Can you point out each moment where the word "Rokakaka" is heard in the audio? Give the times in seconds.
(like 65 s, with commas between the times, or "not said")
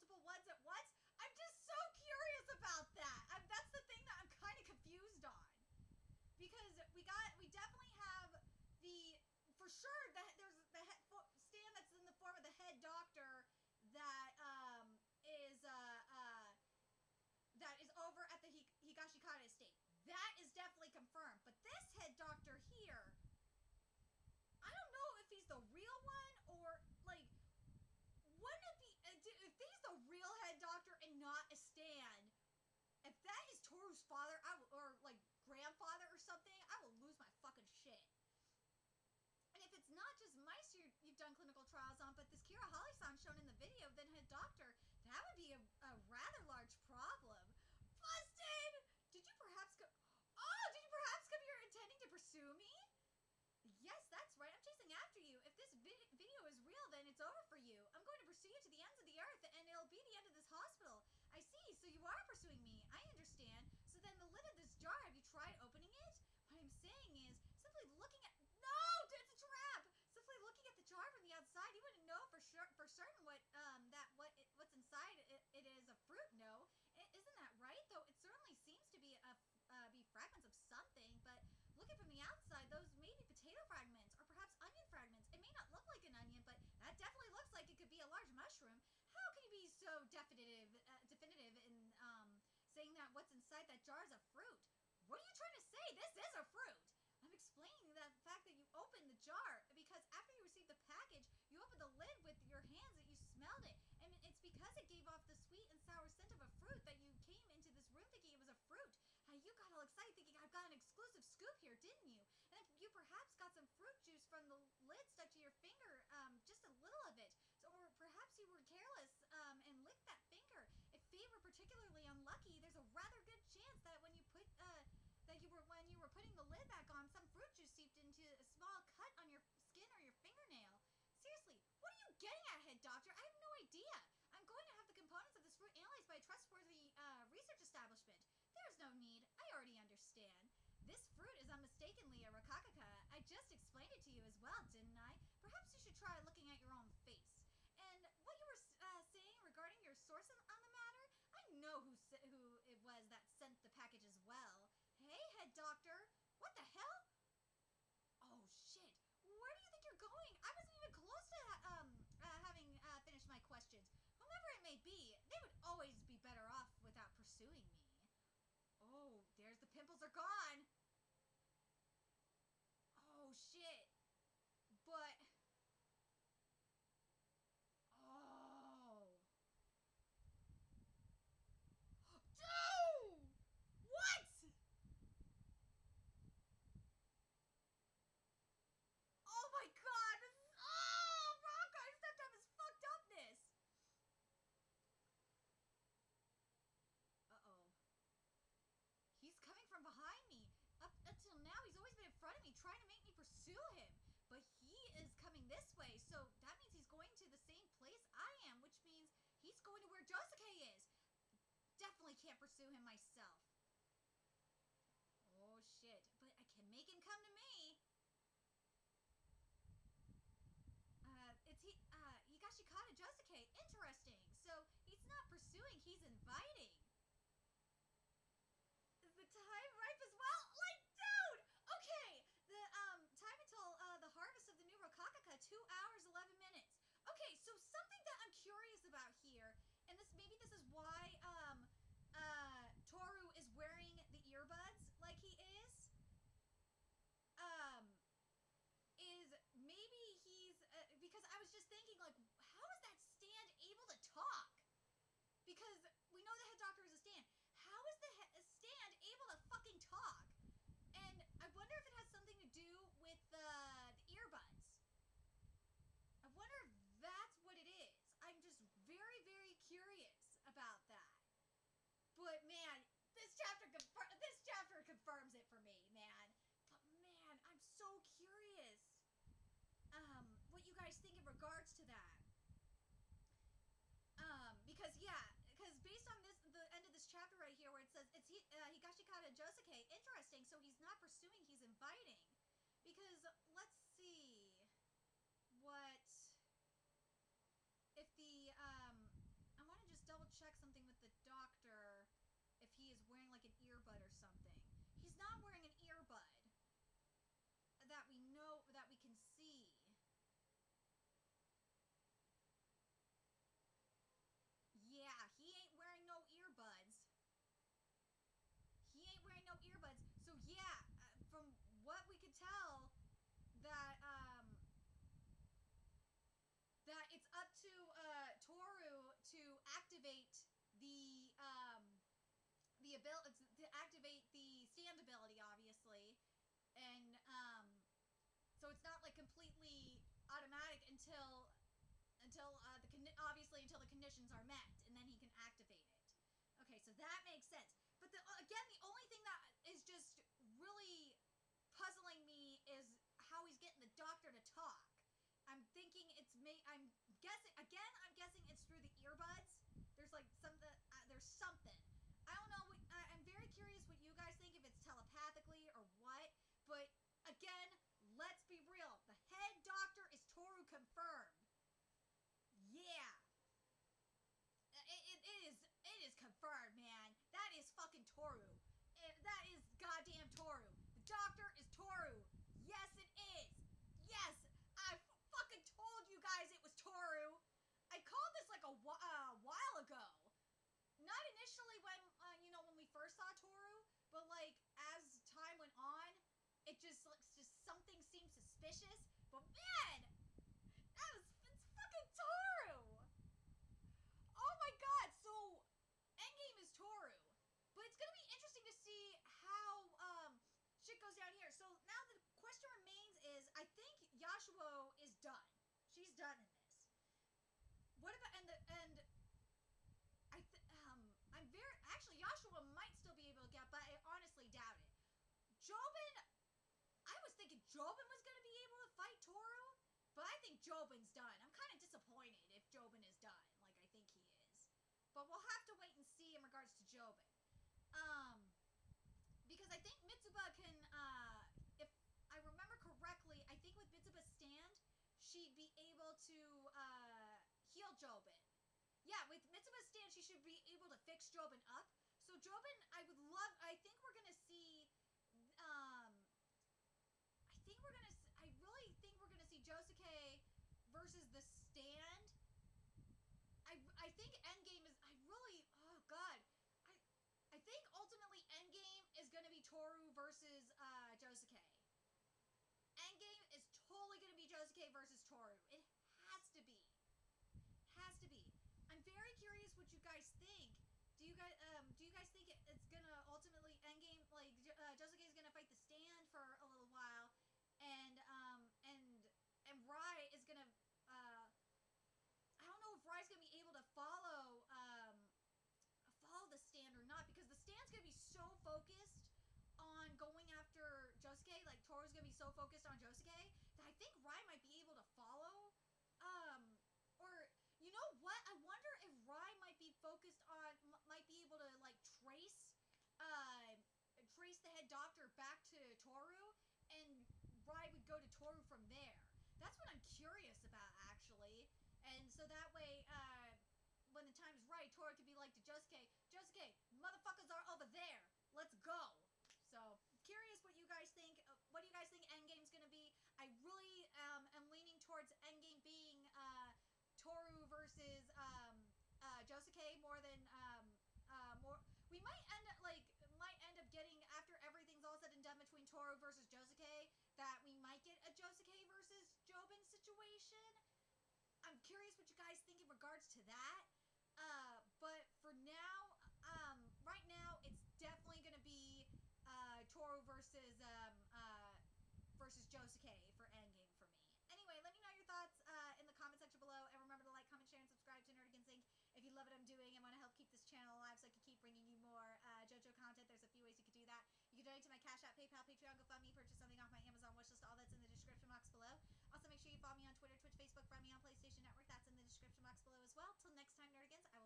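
142 s, 234 s.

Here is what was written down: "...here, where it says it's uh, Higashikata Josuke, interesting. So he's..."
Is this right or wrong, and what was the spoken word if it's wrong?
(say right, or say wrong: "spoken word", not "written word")
right.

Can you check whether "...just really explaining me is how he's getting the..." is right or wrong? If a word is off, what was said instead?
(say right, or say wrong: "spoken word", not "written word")
wrong: "puzzling", not "explaining".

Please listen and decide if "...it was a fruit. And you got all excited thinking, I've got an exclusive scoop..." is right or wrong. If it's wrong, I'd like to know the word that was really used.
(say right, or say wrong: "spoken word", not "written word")
right.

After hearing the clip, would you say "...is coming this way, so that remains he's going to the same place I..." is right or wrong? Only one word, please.
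wrong.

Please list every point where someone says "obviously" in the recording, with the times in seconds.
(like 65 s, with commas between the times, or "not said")
335 s, 343 s.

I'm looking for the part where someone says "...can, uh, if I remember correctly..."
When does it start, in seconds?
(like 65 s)
440 s.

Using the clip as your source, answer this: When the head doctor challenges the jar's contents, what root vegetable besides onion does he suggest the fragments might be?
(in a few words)
Potato.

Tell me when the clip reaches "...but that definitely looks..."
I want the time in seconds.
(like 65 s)
86 s.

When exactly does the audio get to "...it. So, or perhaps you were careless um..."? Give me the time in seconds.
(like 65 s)
117 s.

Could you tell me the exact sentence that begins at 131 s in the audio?
Seriously, what are you getting at, head doctor?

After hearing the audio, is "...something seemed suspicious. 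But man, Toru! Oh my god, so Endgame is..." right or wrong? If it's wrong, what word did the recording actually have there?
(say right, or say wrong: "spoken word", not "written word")
right.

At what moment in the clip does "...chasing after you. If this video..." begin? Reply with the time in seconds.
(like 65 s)
54 s.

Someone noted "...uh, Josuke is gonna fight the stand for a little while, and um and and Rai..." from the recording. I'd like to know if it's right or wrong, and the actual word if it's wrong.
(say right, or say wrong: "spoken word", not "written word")
right.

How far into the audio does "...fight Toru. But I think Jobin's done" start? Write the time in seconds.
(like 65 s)
428 s.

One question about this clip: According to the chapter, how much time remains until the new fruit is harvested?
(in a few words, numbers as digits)
2 hours, 11 minutes.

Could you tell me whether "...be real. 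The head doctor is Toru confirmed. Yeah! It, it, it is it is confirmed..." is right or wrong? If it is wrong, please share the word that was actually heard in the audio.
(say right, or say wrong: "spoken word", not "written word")
right.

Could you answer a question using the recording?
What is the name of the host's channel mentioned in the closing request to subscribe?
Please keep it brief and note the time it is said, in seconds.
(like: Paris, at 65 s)
Nerdigans Inc, at 568 s.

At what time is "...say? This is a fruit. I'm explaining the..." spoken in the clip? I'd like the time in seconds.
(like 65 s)
95 s.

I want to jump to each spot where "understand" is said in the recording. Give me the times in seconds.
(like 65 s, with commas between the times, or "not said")
63 s, 139 s.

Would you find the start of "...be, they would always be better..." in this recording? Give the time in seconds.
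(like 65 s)
164 s.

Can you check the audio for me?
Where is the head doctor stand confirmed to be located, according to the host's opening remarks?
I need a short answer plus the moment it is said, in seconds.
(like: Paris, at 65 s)
Higashikata estate, at 18 s.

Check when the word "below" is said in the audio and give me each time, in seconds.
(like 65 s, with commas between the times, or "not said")
566 s, 578 s, 582 s.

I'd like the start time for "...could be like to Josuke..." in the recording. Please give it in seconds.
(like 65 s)
525 s.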